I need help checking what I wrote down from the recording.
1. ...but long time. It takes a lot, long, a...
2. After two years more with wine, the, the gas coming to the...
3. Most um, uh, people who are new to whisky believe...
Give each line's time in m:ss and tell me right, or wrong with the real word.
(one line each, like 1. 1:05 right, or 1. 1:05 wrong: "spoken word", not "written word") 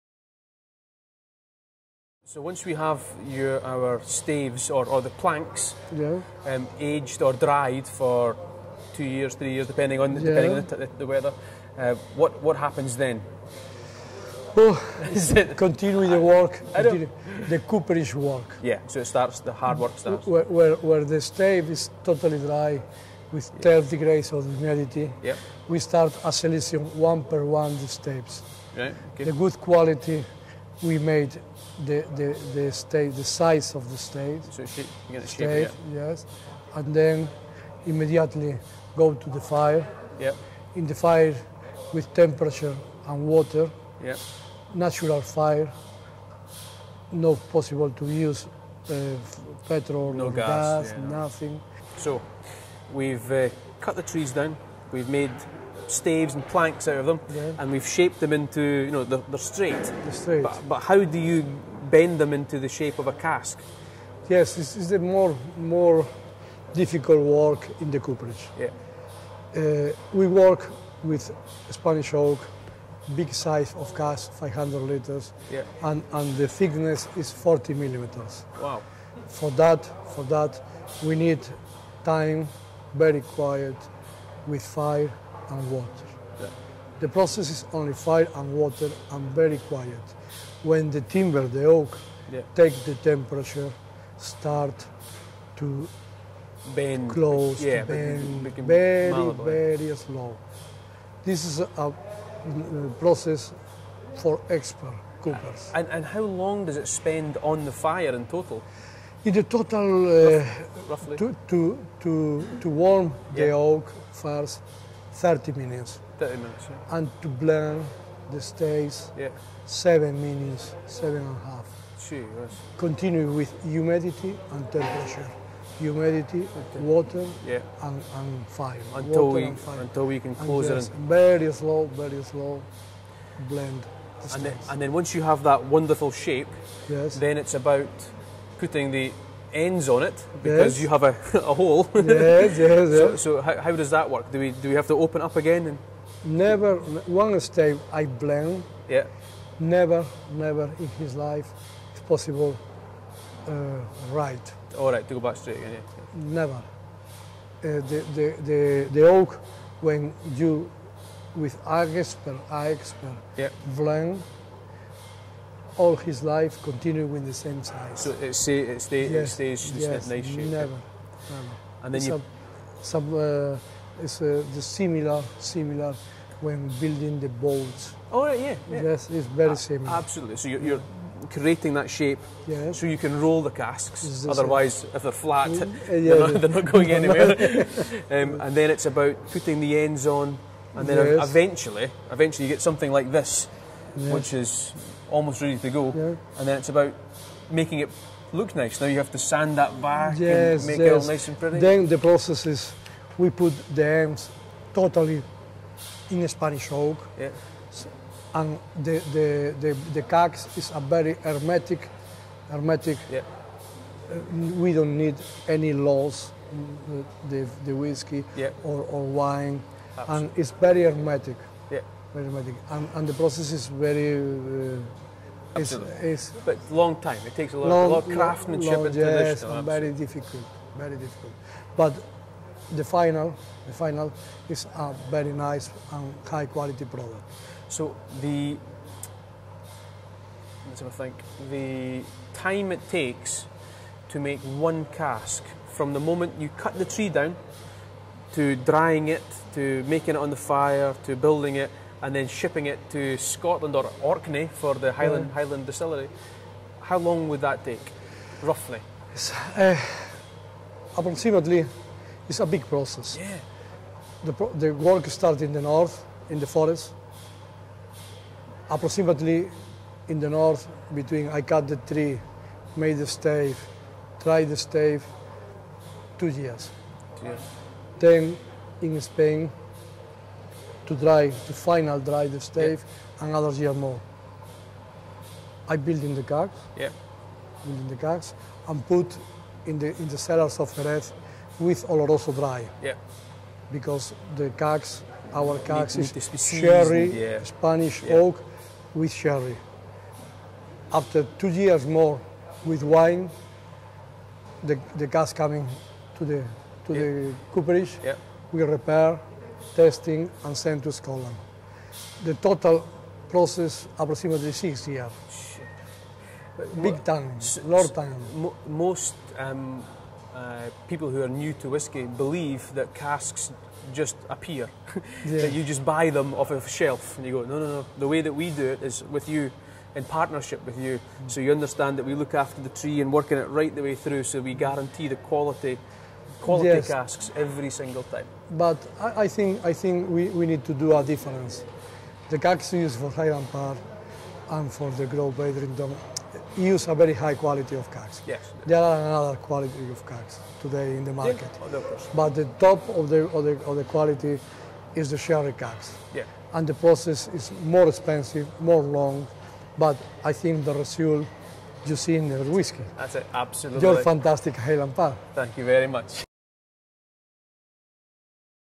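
1. 3:46 right
2. 5:00 right
3. 5:18 right.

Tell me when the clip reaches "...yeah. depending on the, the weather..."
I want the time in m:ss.
0:10.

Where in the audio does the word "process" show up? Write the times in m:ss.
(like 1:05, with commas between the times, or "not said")
1:27, 1:42, 3:21, 3:43, 4:22, 5:13, 5:56.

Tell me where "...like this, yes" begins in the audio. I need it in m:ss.
3:12.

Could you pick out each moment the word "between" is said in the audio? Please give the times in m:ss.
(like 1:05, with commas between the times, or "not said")
4:30.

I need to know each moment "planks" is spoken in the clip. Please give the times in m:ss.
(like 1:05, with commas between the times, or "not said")
0:05, 0:56.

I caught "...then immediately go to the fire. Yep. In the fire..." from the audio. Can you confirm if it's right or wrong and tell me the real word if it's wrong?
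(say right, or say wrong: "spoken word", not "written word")
right.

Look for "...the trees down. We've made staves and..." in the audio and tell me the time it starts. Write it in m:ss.
0:53.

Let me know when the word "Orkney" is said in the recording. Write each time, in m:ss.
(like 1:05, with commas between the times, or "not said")
4:14.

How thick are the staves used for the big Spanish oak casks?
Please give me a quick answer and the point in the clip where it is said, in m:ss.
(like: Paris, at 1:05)
40 millimeters, at 1:17.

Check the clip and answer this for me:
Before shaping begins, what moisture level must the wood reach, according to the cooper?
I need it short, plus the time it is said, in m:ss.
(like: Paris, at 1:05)
12 degrees of humidity, at 0:23.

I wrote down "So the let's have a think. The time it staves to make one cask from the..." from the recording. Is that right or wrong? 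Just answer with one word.
wrong.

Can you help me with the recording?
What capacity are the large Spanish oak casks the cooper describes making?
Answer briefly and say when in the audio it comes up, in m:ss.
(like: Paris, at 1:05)
500 liters, at 1:14.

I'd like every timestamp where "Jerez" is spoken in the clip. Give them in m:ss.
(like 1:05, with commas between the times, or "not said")
4:50.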